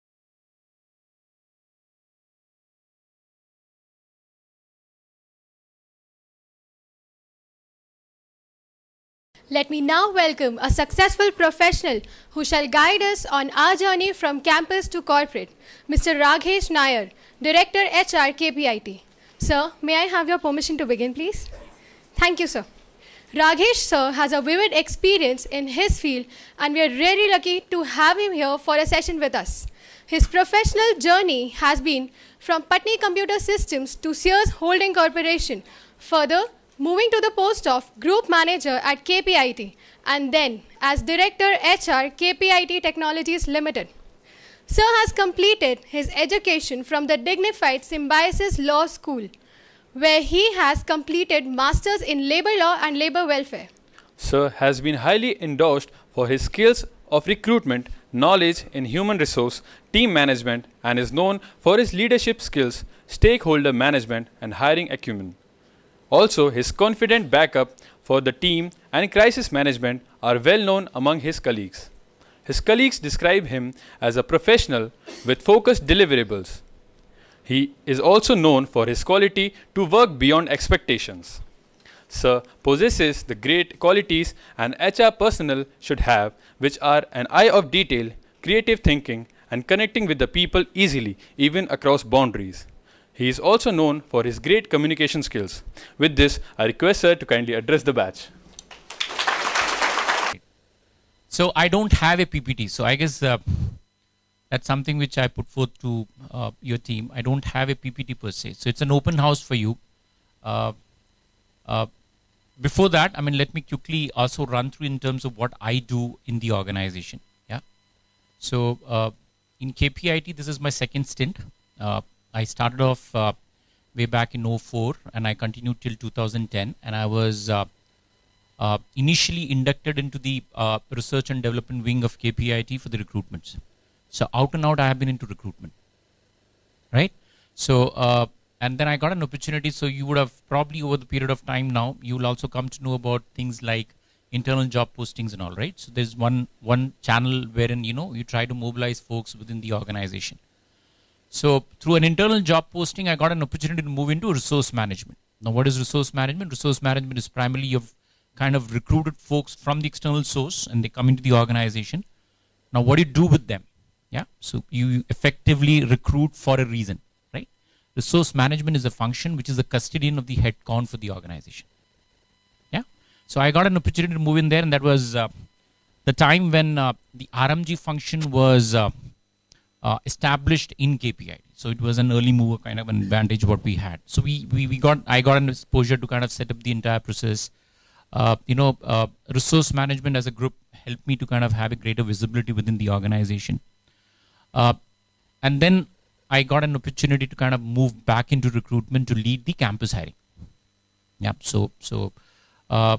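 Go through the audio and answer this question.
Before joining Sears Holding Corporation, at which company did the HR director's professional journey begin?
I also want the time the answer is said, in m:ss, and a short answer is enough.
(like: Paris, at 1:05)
Patni Computer Systems, at 0:32.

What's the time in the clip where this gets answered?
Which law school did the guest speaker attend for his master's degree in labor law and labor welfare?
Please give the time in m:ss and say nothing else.
0:47.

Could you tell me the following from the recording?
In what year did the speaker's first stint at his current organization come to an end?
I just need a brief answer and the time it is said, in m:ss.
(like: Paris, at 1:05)
2010, at 2:05.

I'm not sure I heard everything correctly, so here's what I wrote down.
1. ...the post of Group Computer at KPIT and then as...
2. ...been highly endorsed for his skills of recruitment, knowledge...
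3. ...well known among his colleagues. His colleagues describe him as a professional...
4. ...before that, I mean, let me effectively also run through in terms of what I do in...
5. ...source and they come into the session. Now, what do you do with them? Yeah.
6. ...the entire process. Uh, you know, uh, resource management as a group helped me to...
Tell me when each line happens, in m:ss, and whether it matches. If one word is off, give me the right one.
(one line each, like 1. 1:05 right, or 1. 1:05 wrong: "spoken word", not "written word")
1. 0:37 wrong: "Manager", not "Computer"
2. 0:54 right
3. 1:10 right
4. 1:52 wrong: "quickly", not "effectively"
5. 2:40 wrong: "organization", not "session"
6. 3:06 right.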